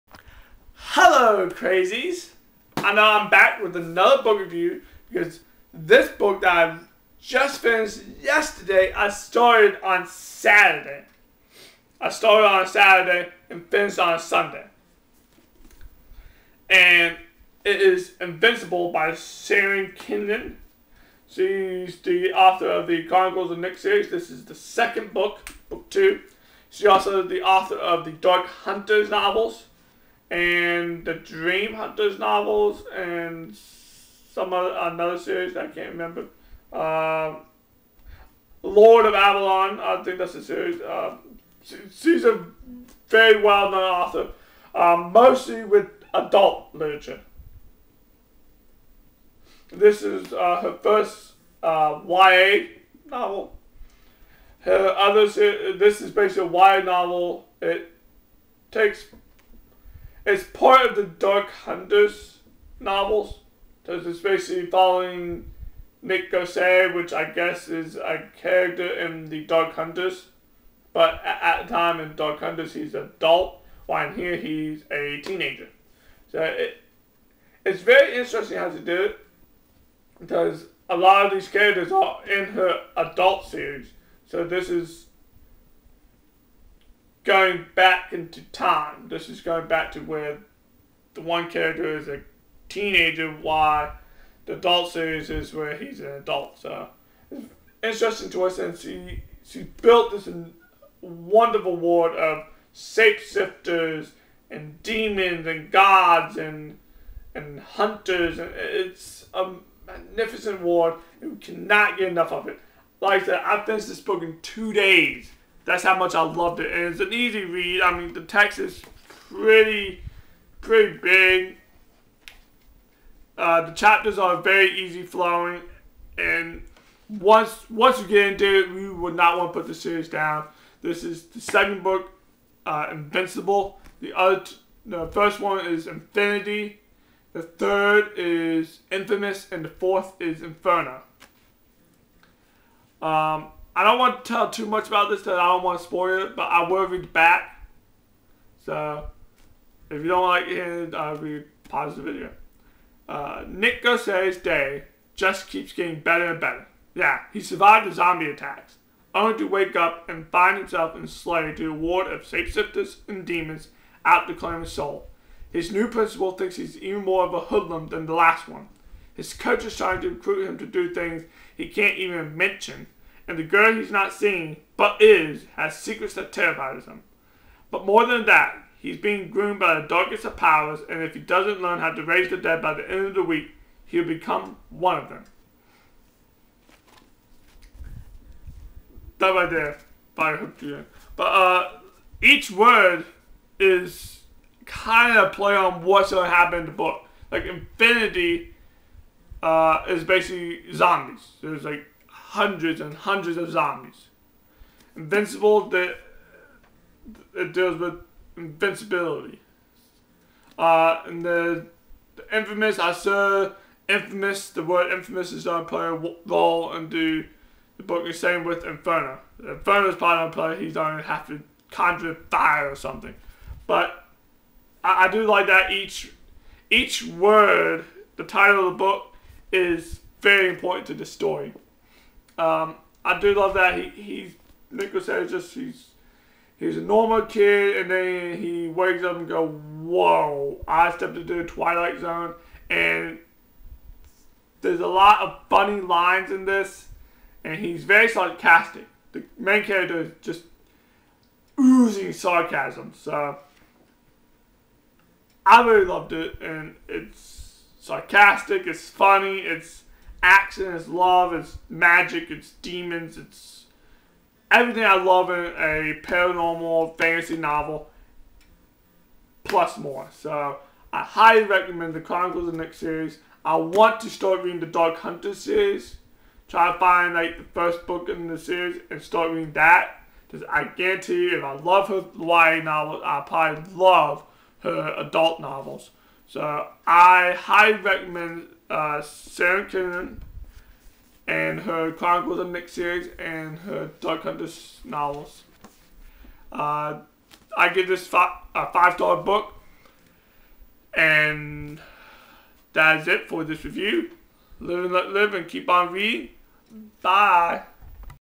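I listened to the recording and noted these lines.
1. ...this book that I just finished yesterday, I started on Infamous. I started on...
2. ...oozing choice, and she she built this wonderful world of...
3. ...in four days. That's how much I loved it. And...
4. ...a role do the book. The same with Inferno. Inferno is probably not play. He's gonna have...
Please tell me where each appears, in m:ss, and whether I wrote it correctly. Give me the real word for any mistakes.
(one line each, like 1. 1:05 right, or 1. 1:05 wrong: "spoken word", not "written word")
1. 0:05 wrong: "Saturday", not "Infamous"
2. 1:38 wrong: "interesting", not "oozing"
3. 1:54 wrong: "two", not "four"
4. 3:35 right.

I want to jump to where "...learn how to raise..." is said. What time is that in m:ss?
3:01.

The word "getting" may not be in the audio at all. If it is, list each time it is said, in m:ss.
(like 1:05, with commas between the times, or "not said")
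2:35.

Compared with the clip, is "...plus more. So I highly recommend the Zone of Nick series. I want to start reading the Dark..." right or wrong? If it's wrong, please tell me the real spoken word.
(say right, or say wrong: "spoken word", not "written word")
wrong: "Chronicles", not "Zone".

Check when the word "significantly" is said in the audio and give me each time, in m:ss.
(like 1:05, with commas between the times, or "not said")
not said.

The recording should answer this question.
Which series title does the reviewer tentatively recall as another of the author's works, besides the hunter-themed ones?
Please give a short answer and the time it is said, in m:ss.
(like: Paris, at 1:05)
Lord of Avalon, at 0:38.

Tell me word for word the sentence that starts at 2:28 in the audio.
So, if you don't like it, I'll be pause the video.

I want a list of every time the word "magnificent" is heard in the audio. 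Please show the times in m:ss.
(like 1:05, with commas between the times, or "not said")
1:49.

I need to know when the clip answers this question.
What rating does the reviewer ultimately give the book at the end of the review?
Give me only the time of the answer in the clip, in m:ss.
4:58.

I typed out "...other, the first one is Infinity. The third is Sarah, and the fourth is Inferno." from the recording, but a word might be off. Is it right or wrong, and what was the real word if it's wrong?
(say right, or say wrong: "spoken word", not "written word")
wrong: "Infamous", not "Sarah".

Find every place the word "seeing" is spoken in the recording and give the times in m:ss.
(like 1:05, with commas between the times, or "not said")
2:54.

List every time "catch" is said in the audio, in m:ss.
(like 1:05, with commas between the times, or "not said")
not said.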